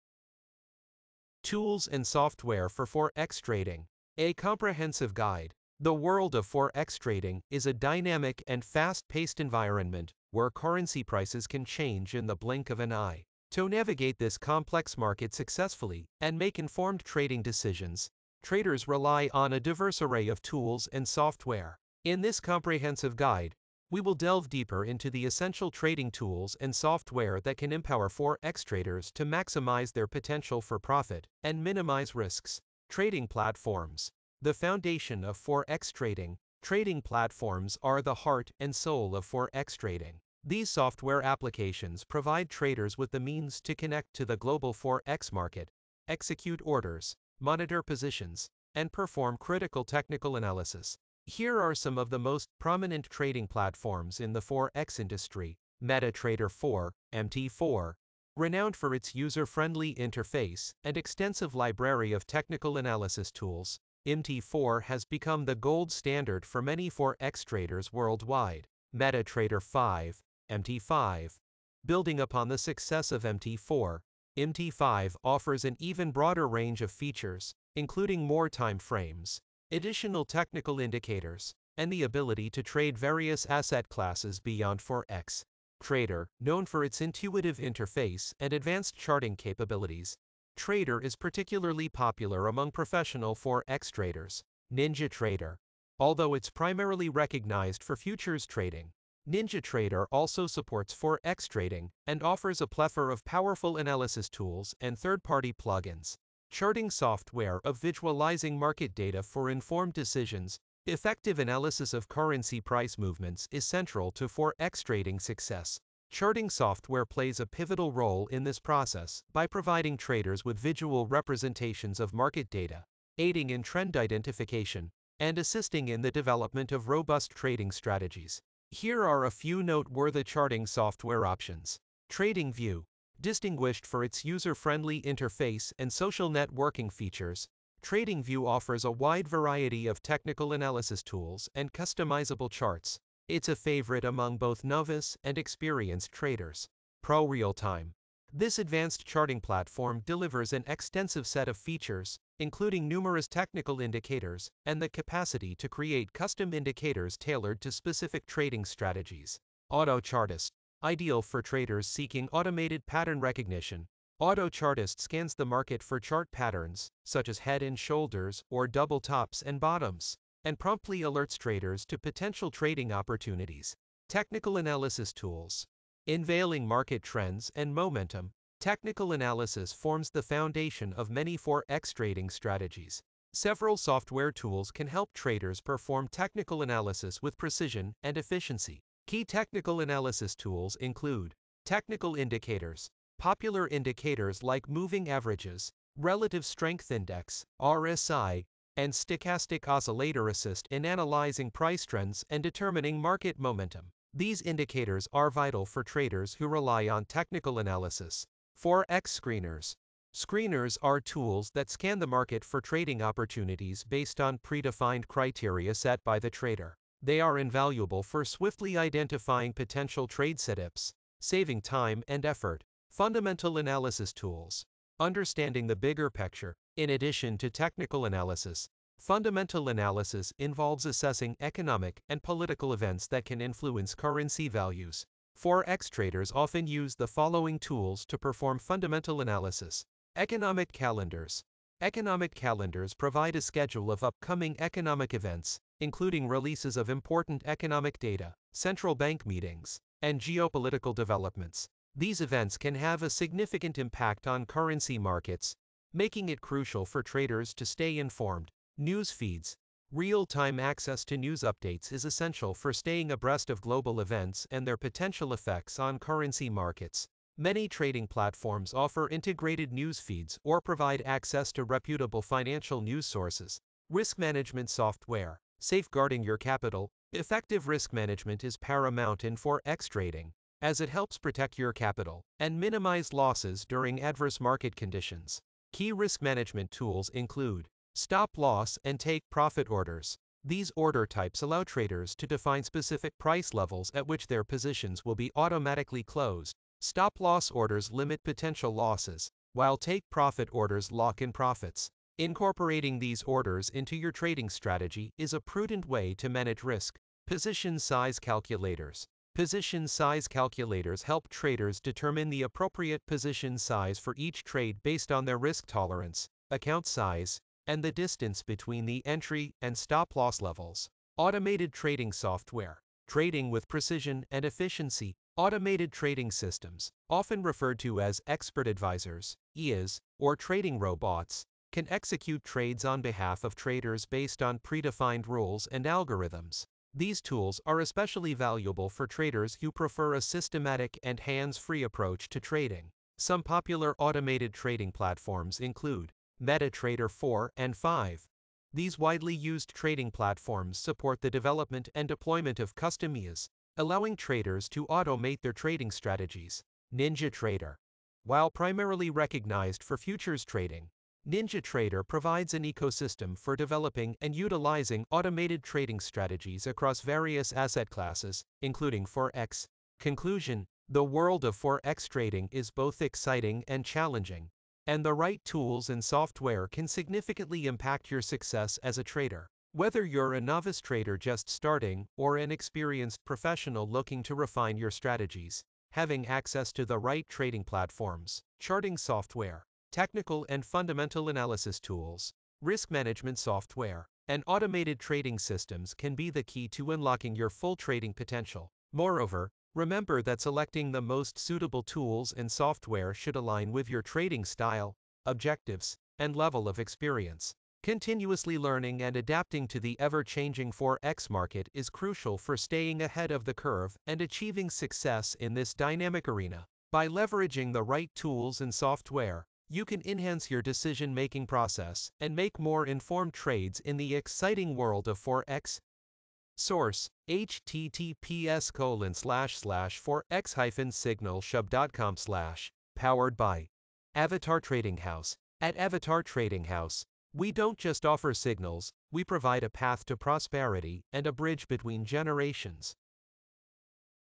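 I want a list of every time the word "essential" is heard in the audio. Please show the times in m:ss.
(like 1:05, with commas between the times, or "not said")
0:25, 4:22.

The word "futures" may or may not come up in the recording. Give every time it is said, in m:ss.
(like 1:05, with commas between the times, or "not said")
1:37, 5:59.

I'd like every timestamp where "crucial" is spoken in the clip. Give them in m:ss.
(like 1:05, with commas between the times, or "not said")
4:16, 6:51.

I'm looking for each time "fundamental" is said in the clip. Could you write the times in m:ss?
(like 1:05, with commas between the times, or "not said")
3:42, 3:48, 3:58, 6:30.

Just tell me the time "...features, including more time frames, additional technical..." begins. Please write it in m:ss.
1:16.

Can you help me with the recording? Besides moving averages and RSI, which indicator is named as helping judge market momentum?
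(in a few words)
stochastic oscillator.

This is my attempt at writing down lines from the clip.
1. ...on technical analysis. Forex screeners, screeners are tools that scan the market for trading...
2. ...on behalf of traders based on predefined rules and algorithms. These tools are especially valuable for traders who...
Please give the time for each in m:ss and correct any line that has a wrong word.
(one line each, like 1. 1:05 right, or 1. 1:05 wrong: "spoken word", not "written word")
1. 3:26 right
2. 5:32 right.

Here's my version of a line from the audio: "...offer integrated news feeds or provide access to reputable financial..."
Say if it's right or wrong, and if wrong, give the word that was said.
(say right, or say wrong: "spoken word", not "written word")
right.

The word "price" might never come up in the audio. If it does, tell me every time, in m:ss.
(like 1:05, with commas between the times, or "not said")
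0:11, 1:52, 3:21, 4:53.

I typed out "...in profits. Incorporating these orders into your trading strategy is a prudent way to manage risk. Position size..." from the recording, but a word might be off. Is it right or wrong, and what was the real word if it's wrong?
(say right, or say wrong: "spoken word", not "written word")
right.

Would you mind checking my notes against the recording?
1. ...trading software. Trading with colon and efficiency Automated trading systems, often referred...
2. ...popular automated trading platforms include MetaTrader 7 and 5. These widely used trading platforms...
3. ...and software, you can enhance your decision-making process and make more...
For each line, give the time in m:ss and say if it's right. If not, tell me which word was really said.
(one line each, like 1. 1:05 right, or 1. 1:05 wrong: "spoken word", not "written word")
1. 5:21 wrong: "precision", not "colon"
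2. 5:43 wrong: "4", not "7"
3. 6:58 right.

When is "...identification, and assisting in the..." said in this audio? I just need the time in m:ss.
2:03.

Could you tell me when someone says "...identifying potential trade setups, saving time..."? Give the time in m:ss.
3:38.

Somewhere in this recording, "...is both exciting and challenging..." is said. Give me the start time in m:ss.
6:12.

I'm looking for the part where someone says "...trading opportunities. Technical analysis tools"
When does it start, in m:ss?
2:52.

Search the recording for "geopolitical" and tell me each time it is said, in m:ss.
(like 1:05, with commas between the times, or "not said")
4:10.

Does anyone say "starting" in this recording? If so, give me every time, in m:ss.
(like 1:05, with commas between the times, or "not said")
6:21.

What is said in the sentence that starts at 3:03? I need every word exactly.
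Several software tools can help traders perform technical analysis with precision and efficiency.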